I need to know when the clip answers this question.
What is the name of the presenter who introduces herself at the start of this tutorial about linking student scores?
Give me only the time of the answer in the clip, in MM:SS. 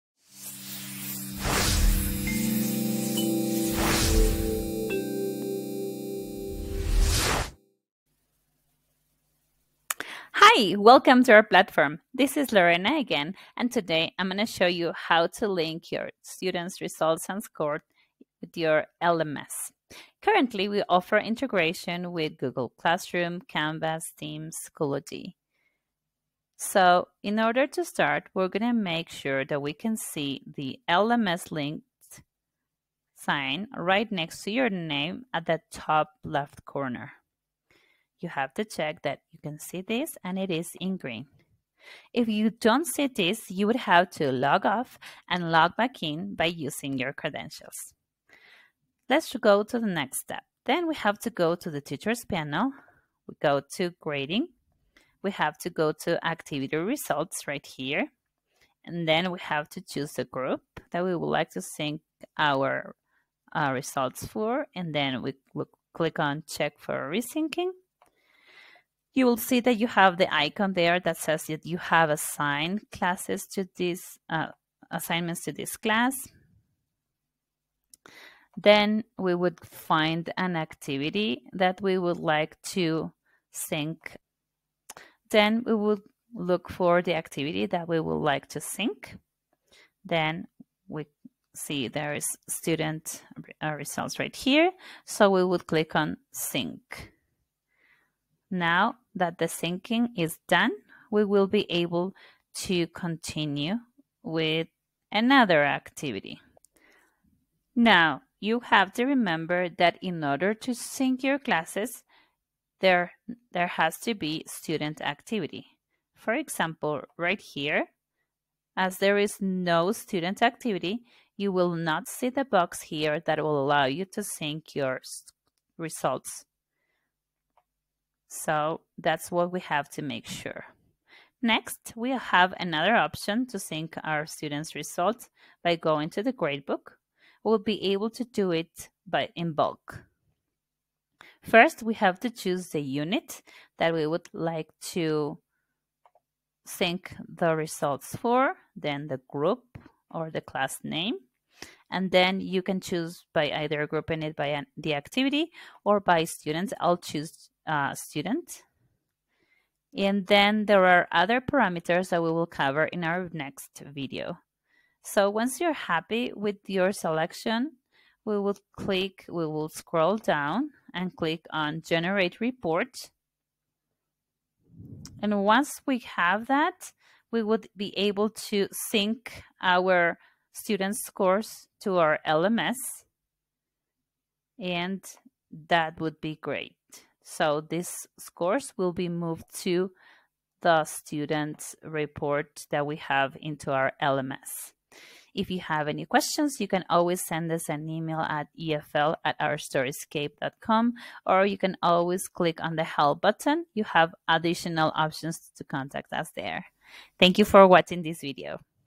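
00:12.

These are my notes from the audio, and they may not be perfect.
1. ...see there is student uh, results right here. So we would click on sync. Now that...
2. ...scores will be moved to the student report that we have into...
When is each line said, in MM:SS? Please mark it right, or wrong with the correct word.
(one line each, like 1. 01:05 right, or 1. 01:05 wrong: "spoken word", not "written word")
1. 01:31 right
2. 03:08 right.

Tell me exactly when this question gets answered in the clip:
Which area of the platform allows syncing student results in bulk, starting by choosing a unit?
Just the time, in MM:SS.
02:16.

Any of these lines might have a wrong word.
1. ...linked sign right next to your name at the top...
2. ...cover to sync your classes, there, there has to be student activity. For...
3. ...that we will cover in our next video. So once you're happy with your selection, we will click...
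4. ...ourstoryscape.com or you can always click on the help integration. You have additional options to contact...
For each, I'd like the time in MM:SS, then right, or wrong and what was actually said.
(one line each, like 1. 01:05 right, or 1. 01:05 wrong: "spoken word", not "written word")
1. 00:31 right
2. 01:50 wrong: "order", not "cover"
3. 02:42 right
4. 03:19 wrong: "button", not "integration".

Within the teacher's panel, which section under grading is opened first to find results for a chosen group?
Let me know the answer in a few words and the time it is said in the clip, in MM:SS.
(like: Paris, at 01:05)
activity results, at 00:56.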